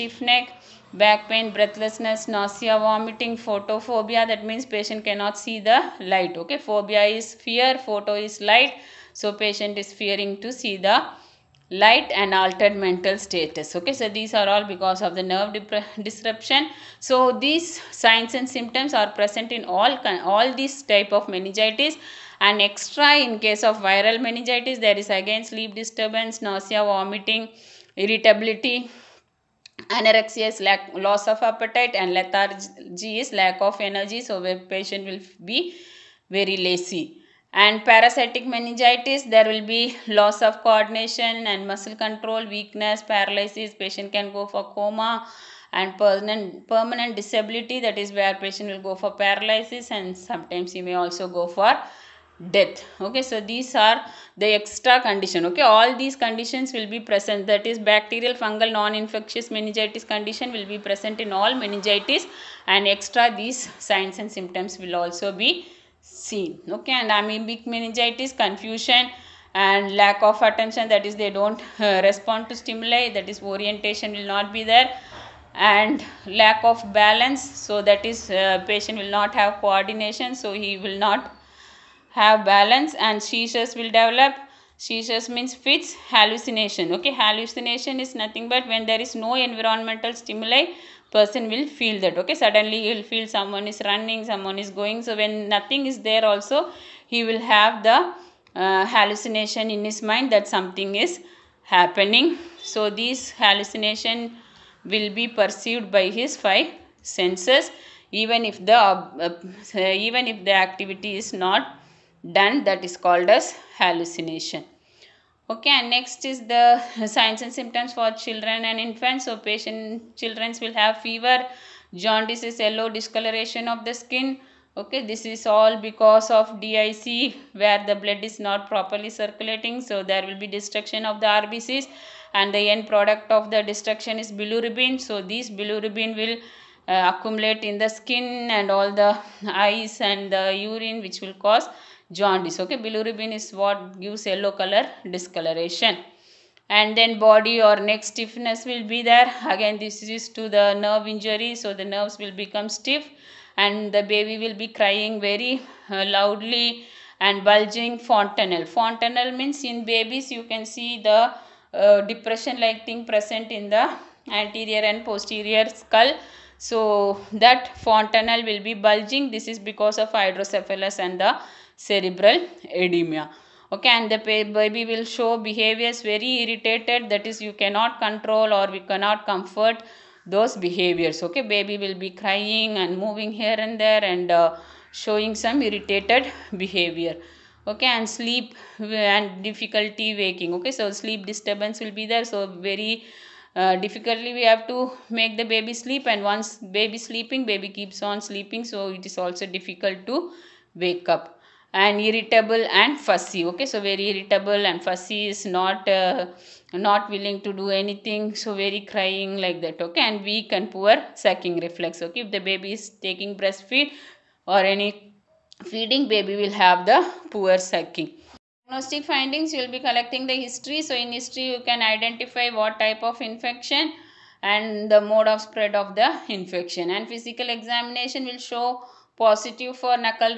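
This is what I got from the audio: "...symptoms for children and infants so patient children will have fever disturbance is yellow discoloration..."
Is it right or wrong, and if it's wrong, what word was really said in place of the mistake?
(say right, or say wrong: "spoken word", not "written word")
wrong: "jaundice", not "disturbance".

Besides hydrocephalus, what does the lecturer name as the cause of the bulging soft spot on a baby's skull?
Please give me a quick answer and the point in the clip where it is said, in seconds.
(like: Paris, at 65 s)
Cerebral edema, at 171 s.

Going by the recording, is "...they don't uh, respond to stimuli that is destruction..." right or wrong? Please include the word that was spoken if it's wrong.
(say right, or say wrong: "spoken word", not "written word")
wrong: "orientation", not "destruction".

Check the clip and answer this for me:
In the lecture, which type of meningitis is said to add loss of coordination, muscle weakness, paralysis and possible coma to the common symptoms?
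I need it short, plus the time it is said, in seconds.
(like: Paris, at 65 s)
Parasitic, at 37 s.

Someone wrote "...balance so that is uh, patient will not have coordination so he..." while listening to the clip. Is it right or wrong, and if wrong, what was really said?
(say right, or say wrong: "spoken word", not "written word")
right.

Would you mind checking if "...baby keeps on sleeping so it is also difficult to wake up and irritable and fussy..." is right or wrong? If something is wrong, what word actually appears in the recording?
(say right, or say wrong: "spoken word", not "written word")
right.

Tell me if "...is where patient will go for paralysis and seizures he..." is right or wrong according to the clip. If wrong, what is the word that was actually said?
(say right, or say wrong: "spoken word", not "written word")
wrong: "sometimes", not "seizures".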